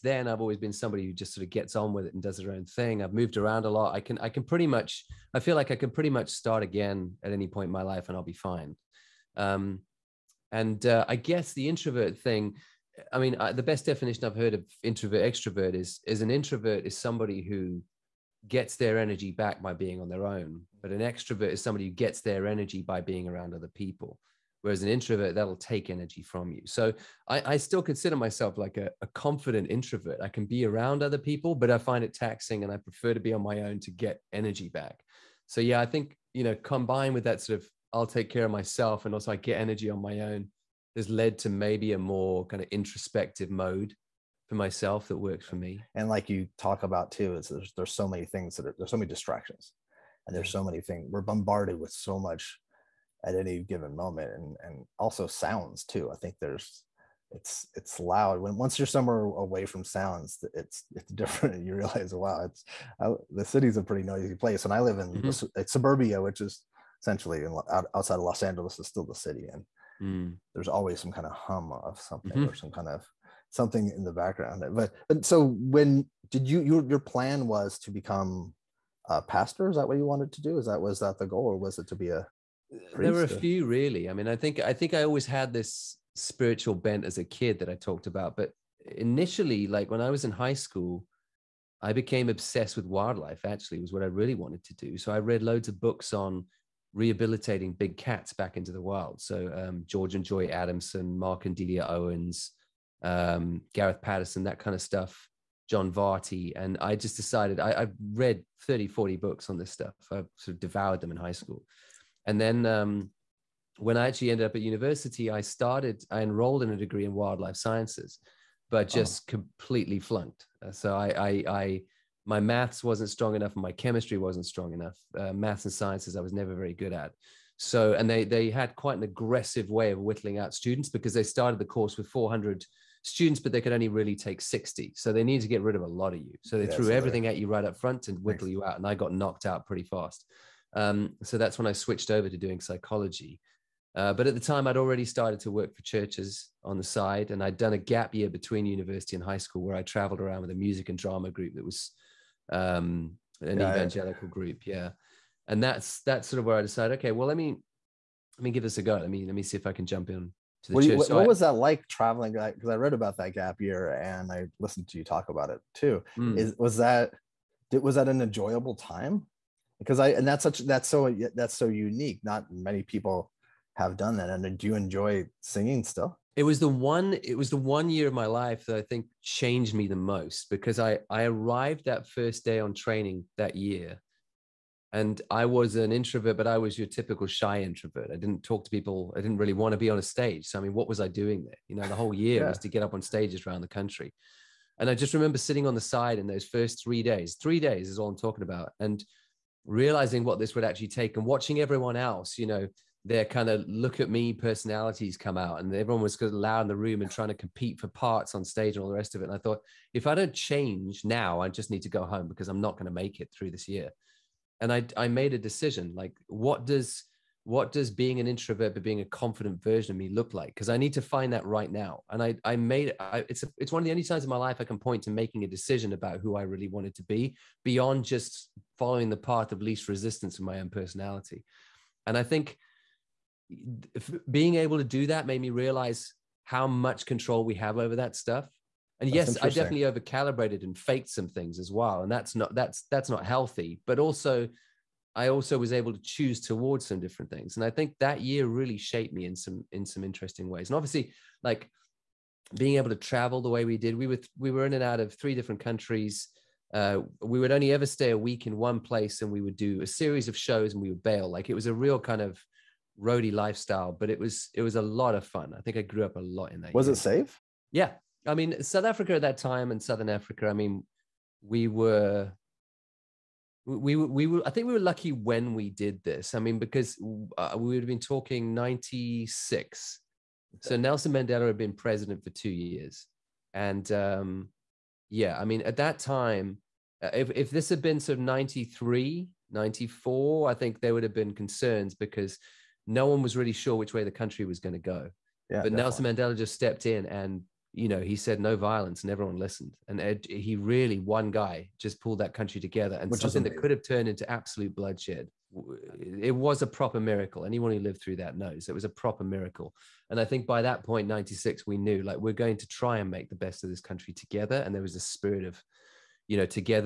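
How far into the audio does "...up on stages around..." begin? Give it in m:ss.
3:12.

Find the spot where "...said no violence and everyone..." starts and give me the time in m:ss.
4:58.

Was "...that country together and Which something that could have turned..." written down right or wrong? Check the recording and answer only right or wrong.
right.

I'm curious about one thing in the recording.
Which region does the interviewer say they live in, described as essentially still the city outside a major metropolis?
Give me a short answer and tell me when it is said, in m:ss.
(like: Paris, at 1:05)
suburbia, at 1:05.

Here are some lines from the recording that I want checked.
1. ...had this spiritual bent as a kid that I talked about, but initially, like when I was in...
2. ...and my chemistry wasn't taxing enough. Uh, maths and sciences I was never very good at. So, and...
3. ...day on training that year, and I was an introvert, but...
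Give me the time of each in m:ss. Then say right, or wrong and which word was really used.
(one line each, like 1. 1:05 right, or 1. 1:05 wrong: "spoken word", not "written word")
1. 1:25 right
2. 2:03 wrong: "strong", not "taxing"
3. 3:02 right.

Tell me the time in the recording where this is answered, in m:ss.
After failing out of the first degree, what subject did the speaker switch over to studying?
2:22.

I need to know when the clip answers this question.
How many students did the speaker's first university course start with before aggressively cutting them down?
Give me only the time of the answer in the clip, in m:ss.
2:12.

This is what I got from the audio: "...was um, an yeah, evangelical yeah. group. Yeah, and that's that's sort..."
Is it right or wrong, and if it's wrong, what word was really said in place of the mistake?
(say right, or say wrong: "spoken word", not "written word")
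right.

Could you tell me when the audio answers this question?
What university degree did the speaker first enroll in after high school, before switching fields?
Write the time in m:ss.
1:57.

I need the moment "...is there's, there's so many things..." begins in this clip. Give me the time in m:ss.
0:47.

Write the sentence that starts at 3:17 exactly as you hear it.
Three days is all I'm talking about.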